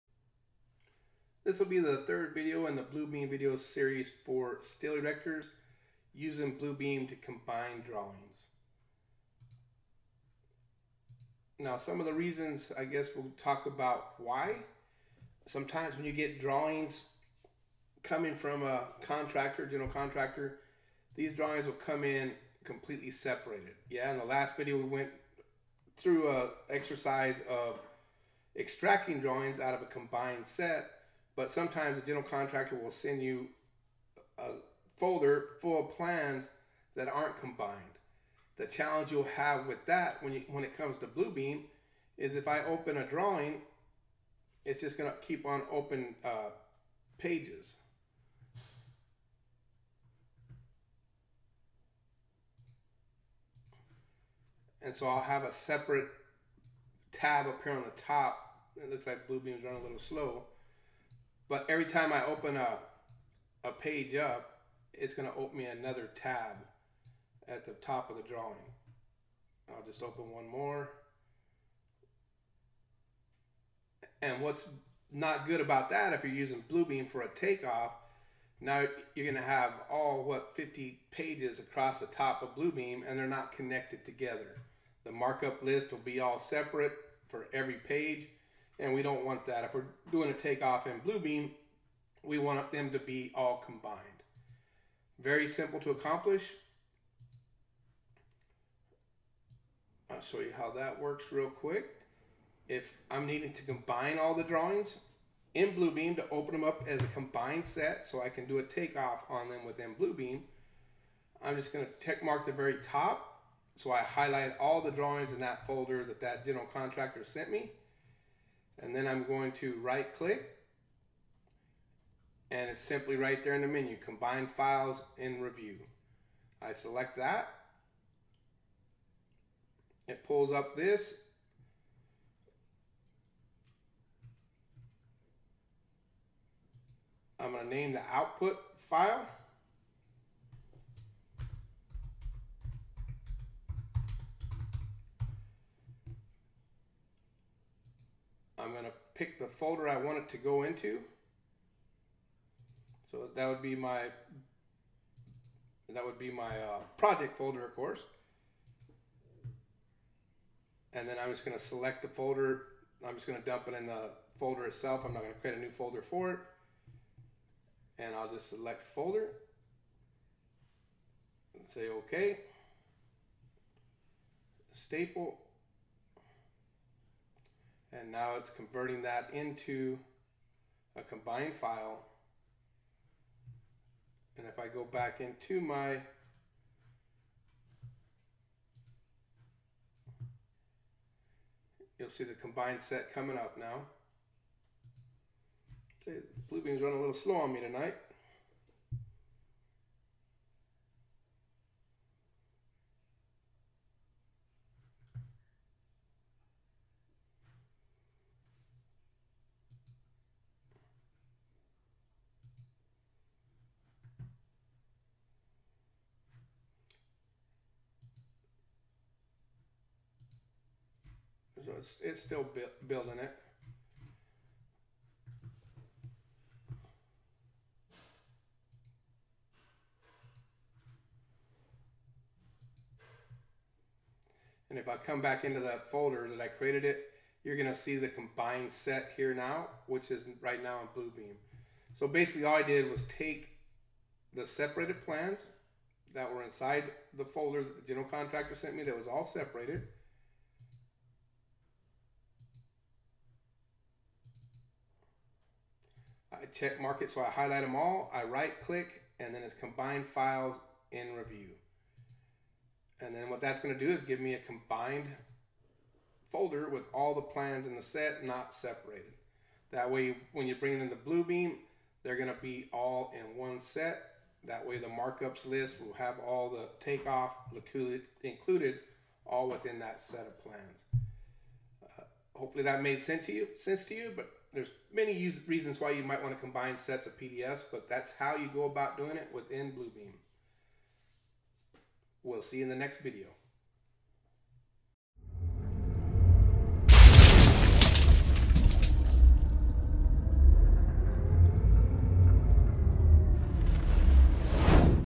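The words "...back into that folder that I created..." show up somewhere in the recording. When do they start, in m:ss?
3:55.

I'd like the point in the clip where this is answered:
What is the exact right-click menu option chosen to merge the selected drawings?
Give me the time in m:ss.
2:04.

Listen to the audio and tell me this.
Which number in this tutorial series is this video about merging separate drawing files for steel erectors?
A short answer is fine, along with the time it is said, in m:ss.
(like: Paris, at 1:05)
third, at 0:02.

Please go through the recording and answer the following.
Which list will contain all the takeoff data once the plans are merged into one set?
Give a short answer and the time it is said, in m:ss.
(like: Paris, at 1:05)
markups list, at 4:34.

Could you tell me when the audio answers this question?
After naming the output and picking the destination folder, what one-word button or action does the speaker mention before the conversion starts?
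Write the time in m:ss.
2:54.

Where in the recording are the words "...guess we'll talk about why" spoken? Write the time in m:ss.
0:12.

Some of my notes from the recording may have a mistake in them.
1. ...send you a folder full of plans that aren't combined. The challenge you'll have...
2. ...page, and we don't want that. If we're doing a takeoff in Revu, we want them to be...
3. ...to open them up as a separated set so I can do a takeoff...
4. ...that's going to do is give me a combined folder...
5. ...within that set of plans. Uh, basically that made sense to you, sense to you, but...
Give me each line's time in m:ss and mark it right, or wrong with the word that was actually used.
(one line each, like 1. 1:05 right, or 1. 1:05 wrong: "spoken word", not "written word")
1. 0:32 right
2. 1:27 wrong: "Bluebeam", not "Revu"
3. 1:46 wrong: "combined", not "separated"
4. 4:23 right
5. 4:39 wrong: "hopefully", not "basically".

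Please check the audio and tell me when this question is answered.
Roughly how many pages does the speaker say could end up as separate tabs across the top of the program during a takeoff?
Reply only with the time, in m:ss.
1:20.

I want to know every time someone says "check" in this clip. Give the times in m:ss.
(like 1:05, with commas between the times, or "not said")
1:52, 4:16.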